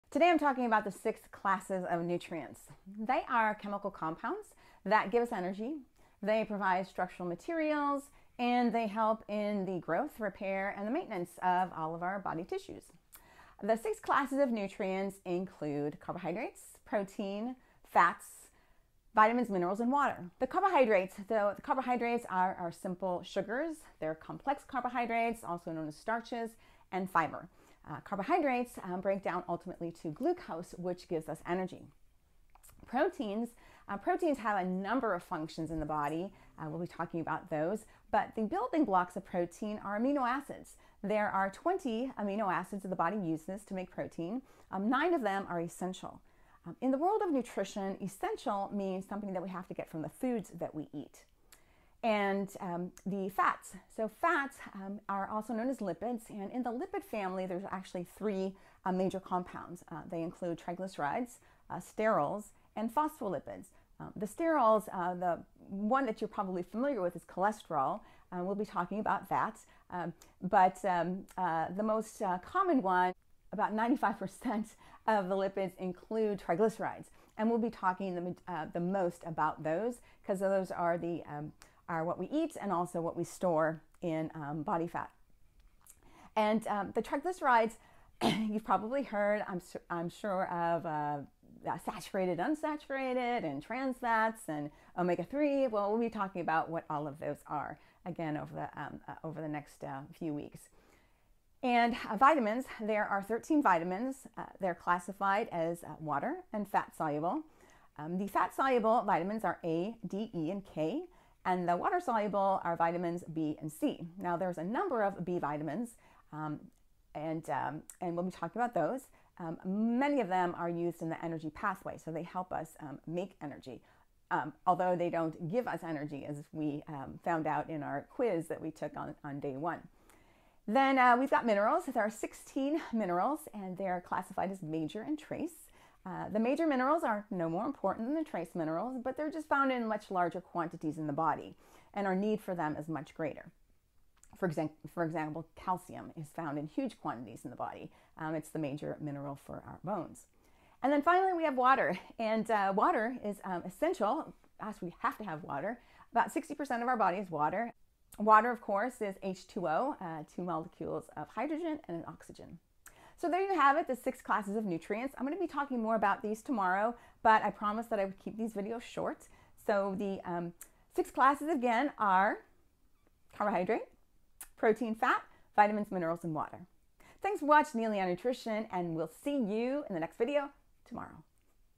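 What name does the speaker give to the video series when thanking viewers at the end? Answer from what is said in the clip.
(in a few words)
Neily on Nutrition.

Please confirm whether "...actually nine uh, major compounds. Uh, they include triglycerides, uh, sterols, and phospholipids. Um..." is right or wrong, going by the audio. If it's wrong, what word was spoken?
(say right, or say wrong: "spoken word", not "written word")
wrong: "three", not "nine".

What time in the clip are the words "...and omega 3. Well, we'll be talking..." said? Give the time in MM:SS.
01:34.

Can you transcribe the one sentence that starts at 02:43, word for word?
So there you have it, the six classes of nutrients.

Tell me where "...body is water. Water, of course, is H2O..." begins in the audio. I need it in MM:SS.
02:36.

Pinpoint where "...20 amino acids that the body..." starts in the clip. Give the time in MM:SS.
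00:41.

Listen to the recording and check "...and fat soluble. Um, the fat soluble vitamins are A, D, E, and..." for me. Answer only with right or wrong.
right.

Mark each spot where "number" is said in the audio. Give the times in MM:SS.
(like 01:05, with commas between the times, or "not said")
00:34, 01:54.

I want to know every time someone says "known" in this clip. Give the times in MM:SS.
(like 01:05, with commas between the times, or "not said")
00:25, 00:55.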